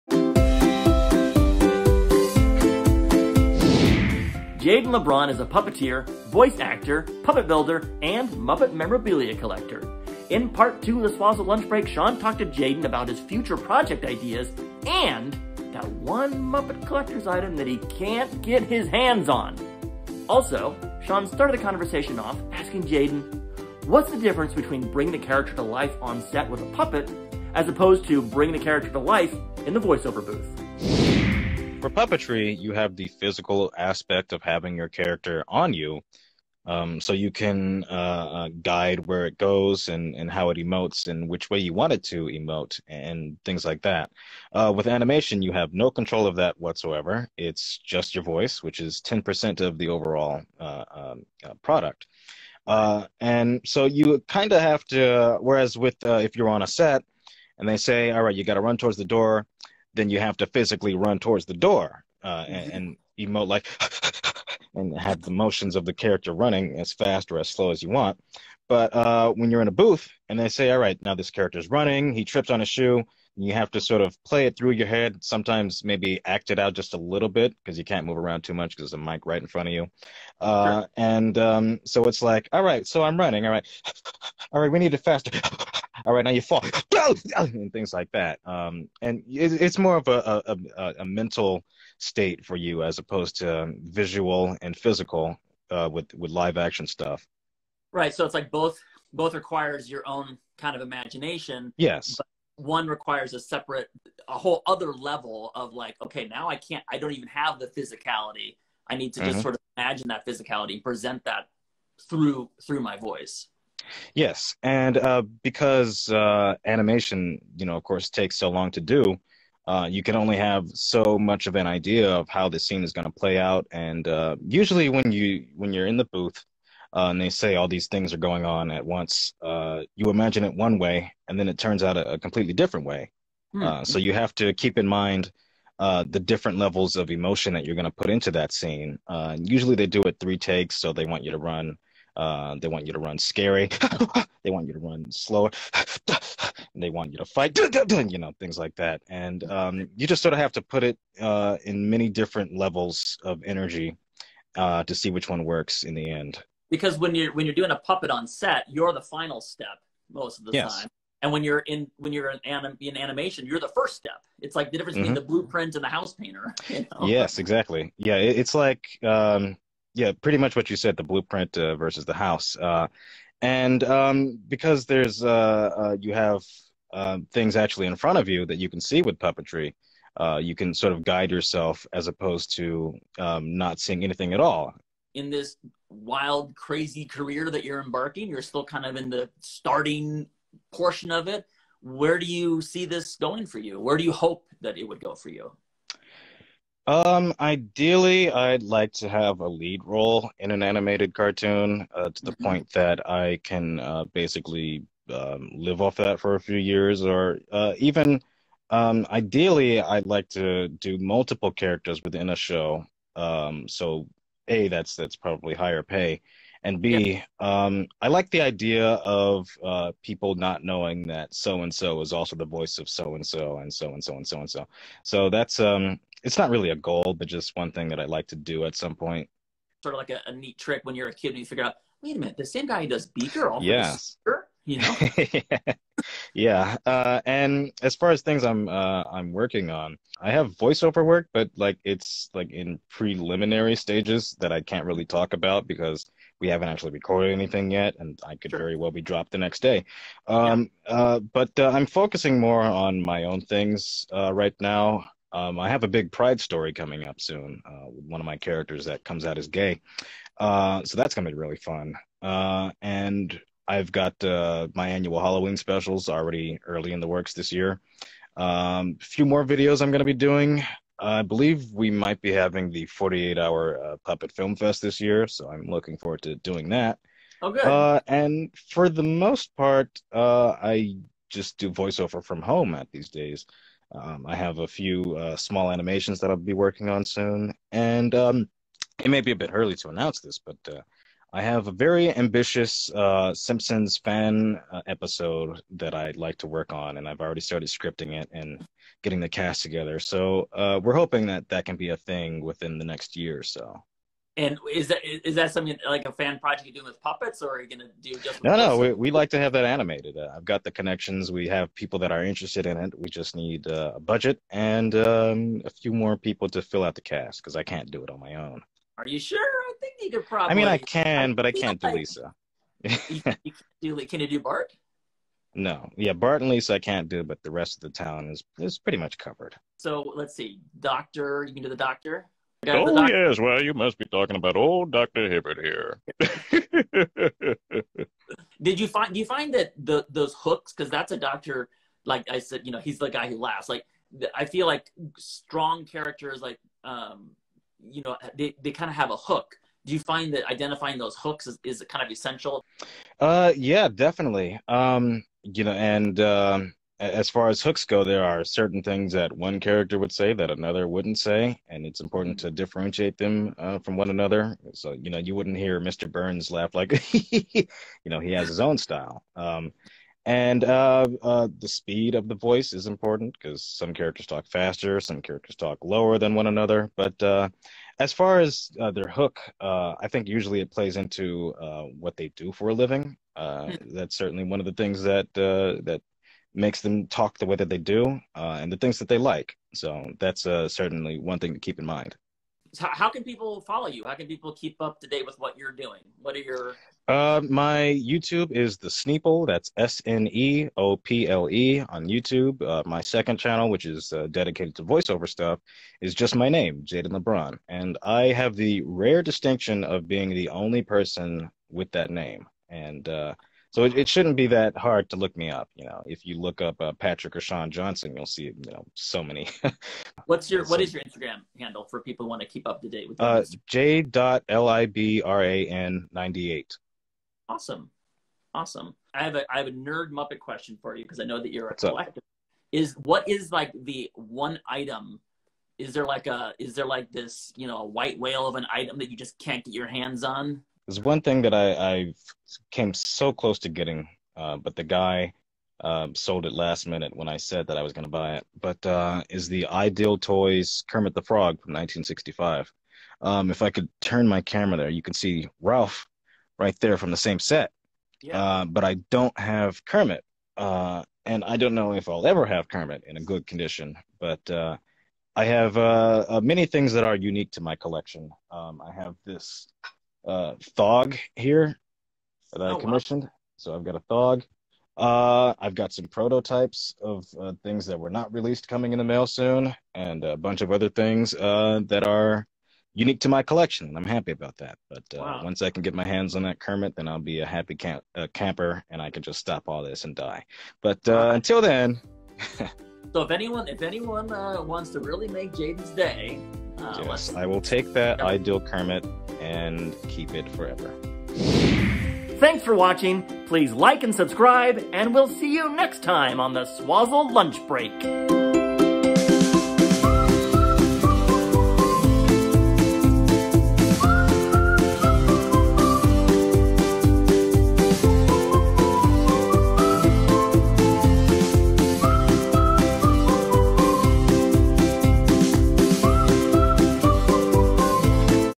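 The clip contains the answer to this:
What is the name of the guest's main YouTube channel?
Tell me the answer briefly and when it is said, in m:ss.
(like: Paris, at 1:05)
the Sneople, at 6:38.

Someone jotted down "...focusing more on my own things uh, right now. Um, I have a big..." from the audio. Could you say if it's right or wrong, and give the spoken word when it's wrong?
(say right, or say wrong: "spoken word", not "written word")
right.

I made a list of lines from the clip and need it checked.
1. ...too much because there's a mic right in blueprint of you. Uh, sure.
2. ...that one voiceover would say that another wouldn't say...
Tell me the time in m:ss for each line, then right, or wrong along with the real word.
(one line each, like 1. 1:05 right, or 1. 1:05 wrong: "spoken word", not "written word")
1. 1:18 wrong: "front", not "blueprint"
2. 5:59 wrong: "character", not "voiceover".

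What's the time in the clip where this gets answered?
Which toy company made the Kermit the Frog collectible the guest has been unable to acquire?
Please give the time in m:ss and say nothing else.
7:29.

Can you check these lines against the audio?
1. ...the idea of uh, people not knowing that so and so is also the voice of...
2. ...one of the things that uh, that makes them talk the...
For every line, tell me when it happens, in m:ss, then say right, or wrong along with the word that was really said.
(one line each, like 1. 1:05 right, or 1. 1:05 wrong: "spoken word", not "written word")
1. 3:38 right
2. 6:24 right.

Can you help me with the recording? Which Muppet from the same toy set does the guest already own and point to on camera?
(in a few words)
Rowlf.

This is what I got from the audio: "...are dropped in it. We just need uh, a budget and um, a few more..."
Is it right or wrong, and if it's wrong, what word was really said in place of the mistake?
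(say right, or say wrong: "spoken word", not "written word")
wrong: "interested", not "dropped".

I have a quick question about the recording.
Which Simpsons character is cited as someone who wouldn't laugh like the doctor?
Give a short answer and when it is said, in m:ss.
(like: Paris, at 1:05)
Mr. Burns, at 6:05.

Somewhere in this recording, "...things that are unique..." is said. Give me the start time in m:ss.
7:46.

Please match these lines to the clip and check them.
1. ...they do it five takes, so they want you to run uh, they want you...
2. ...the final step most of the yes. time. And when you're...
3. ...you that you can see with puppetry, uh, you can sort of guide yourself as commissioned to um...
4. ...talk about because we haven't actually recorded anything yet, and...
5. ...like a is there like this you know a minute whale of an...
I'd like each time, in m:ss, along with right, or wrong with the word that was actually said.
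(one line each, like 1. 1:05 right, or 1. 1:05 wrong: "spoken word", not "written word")
1. 2:19 wrong: "three", not "five"
2. 2:38 right
3. 2:58 wrong: "opposed", not "commissioned"
4. 4:05 right
5. 7:16 wrong: "white", not "minute".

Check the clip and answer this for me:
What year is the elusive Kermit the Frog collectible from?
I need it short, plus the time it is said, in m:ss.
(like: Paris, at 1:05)
1965, at 7:31.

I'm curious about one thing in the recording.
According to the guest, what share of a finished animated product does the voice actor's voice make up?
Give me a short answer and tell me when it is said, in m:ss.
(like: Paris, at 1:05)
10%, at 0:49.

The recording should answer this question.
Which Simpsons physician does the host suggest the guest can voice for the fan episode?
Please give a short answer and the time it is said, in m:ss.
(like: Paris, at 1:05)
Doctor Hibbert, at 5:34.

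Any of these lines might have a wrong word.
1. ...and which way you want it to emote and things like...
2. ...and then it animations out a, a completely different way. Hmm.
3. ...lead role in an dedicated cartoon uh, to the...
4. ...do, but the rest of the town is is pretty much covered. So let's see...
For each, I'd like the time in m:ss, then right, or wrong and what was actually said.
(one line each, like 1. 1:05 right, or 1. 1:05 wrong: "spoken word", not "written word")
1. 0:41 right
2. 2:11 wrong: "turns", not "animations"
3. 3:19 wrong: "animated", not "dedicated"
4. 5:27 right.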